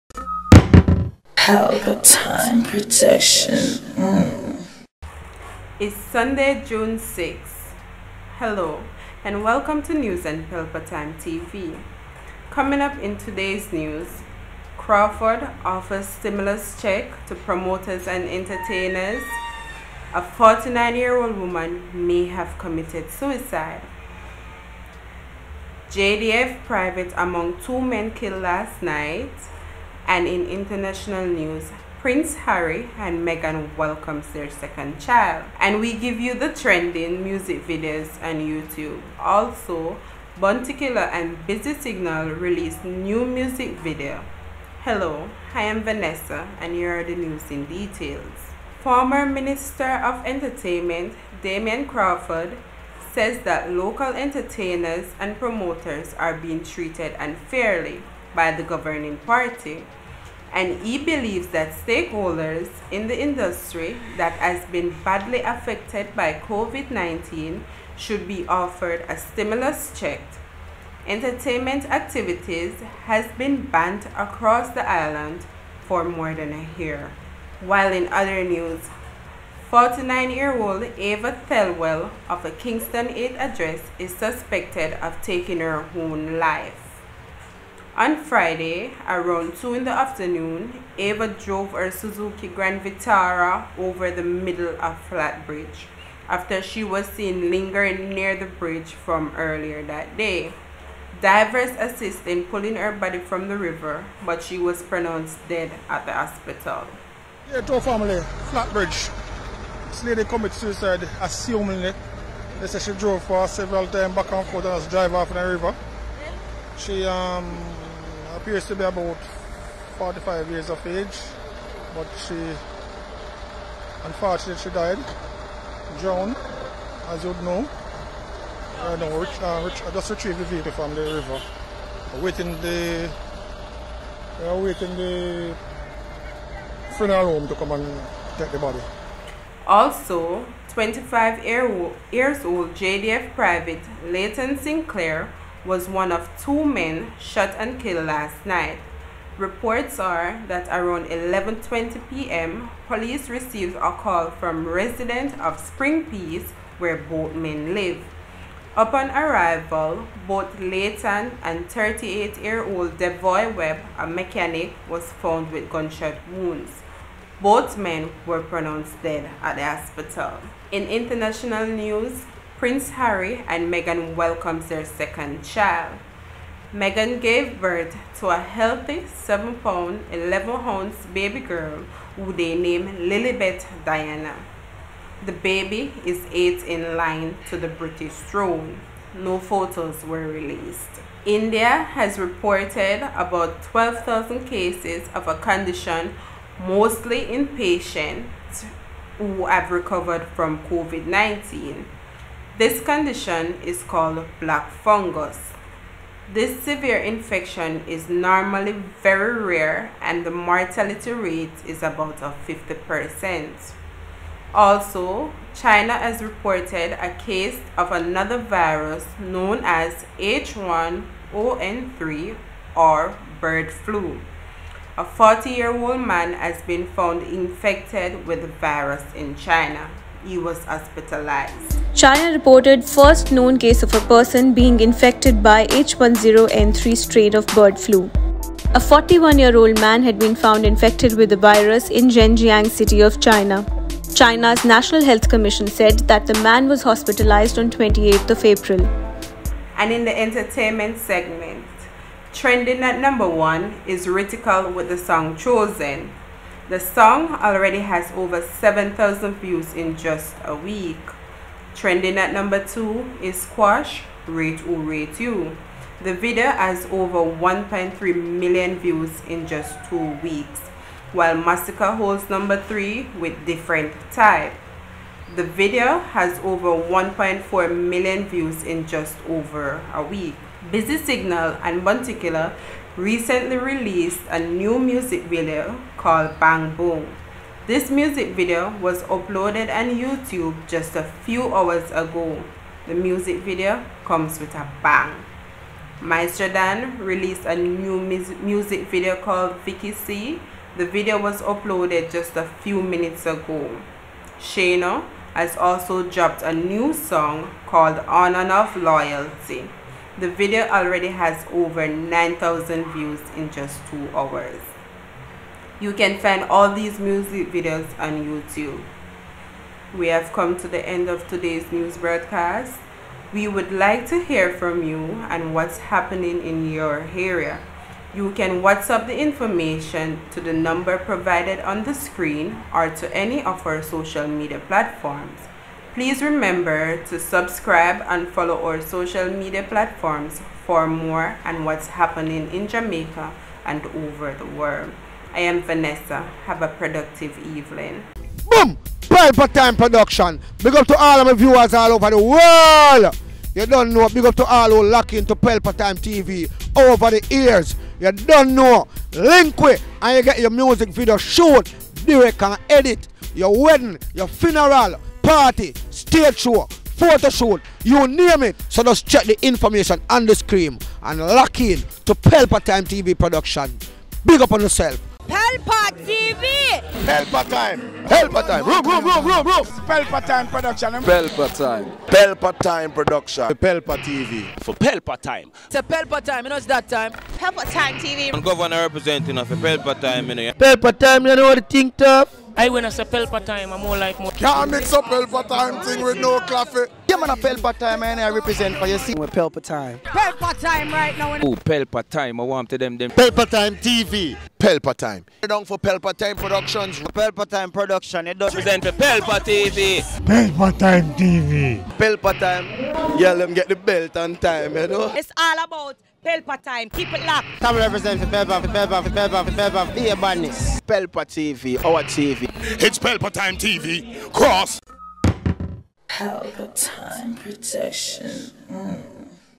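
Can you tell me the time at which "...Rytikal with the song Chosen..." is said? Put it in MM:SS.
04:14.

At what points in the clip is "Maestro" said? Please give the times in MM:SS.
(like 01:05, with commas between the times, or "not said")
04:56.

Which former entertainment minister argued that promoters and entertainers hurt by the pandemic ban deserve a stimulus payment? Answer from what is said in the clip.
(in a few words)
Damien Crawford.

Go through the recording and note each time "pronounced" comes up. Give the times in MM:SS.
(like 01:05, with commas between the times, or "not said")
01:44, 02:48.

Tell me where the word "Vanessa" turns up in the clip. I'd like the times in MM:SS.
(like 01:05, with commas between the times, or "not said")
00:45, 05:45.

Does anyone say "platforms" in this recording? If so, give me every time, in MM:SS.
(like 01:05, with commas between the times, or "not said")
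05:34, 05:39.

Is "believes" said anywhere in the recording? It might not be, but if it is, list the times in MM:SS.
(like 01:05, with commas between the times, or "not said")
01:00.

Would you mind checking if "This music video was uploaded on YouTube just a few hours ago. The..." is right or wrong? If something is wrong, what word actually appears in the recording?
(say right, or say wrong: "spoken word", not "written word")
right.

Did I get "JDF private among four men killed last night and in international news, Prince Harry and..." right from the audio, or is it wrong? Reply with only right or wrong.
wrong.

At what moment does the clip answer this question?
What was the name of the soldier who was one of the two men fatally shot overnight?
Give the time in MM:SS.
02:24.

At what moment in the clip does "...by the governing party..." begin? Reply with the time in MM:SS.
00:58.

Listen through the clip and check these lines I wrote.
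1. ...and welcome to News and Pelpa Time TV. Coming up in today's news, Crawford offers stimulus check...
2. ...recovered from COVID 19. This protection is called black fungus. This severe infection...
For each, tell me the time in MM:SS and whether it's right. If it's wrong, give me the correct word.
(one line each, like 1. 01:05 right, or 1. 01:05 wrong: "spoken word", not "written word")
1. 00:09 right
2. 03:19 wrong: "condition", not "protection".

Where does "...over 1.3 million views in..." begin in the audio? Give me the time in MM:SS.
04:26.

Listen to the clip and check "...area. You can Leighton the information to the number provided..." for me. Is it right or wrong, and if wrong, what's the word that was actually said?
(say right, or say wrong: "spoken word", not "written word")
wrong: "WhatsApp", not "Leighton".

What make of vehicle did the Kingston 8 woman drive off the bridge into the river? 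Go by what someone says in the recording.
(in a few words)
Suzuki Grand Vitara.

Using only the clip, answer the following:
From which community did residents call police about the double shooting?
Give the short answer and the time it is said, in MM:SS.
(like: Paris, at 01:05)
Spring Peace, at 02:35.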